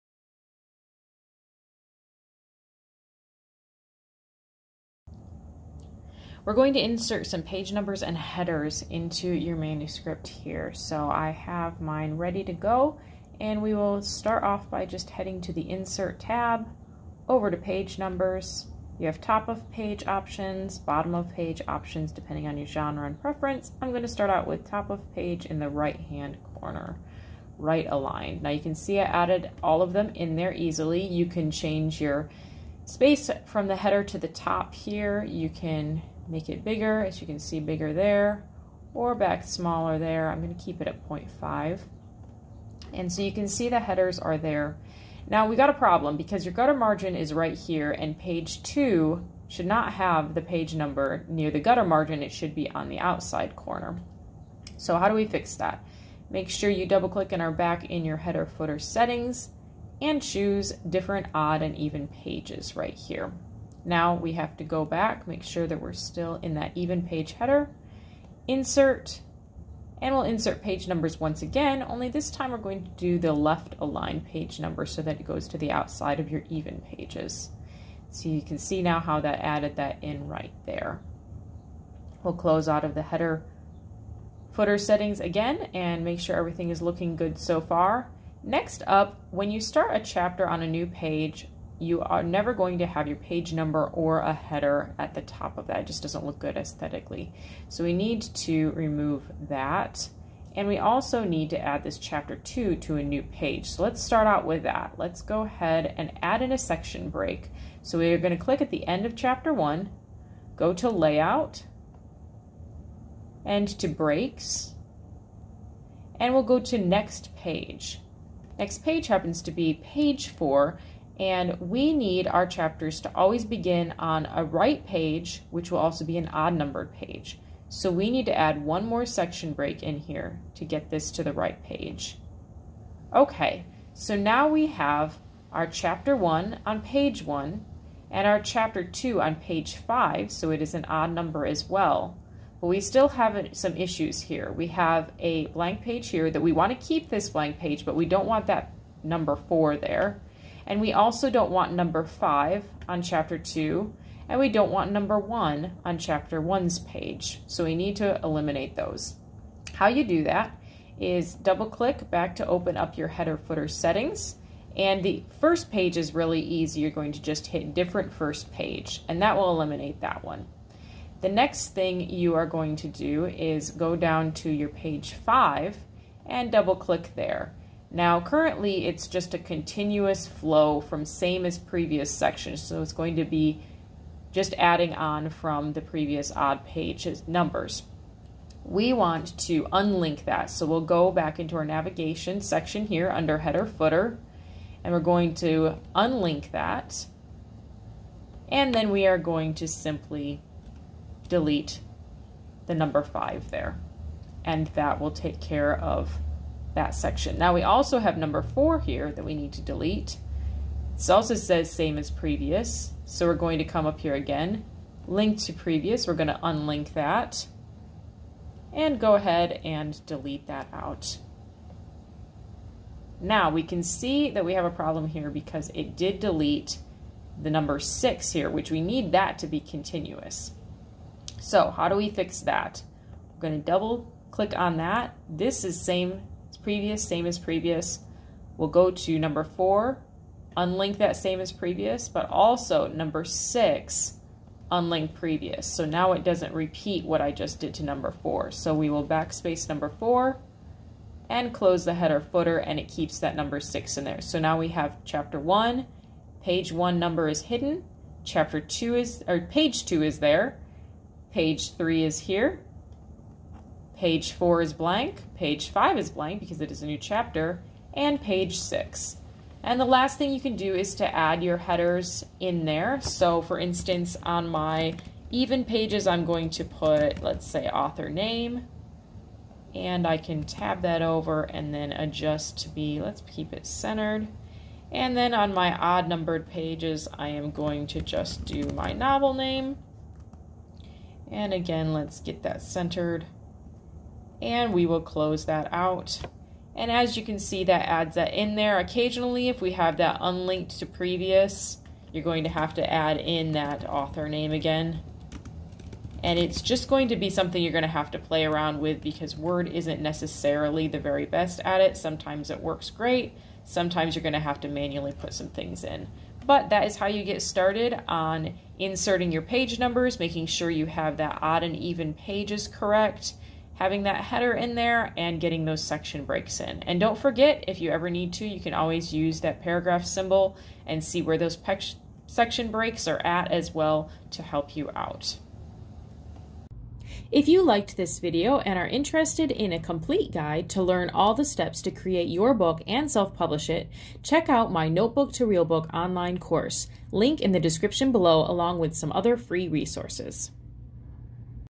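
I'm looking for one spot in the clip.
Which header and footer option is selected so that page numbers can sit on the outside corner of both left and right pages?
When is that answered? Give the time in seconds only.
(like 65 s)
60 s.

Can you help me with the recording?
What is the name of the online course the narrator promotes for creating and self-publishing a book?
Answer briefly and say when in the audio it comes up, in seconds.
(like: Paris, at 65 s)
Notebook to Real Book, at 344 s.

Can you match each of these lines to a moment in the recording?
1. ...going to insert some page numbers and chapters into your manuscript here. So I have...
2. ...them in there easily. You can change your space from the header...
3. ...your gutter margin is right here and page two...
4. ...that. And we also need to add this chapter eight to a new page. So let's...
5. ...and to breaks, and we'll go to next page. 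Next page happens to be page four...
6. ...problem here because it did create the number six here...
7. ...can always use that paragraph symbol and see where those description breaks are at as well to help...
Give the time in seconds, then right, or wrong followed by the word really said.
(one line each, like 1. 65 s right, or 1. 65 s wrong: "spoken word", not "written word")
1. 6 s wrong: "headers", not "chapters"
2. 29 s right
3. 46 s right
4. 99 s wrong: "two", not "eight"
5. 113 s right
6. 224 s wrong: "delete", not "create"
7. 328 s wrong: "section", not "description".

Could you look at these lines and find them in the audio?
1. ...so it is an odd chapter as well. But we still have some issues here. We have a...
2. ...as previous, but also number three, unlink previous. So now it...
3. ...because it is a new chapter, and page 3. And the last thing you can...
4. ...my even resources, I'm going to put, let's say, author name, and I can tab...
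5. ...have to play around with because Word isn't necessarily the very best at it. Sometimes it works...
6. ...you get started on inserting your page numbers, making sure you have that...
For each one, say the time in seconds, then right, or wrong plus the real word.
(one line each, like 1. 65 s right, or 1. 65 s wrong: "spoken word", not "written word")
1. 140 s wrong: "number", not "chapter"
2. 241 s wrong: "six", not "three"
3. 266 s wrong: "6", not "3"
4. 274 s wrong: "pages", not "resources"
5. 307 s right
6. 317 s right.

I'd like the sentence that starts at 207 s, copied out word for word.
Now we also have number four here that we need to delete.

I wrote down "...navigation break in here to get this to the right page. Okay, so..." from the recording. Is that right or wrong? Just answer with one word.
wrong.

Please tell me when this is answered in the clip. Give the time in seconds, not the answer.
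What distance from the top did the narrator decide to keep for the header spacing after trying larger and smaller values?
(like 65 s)
41 s.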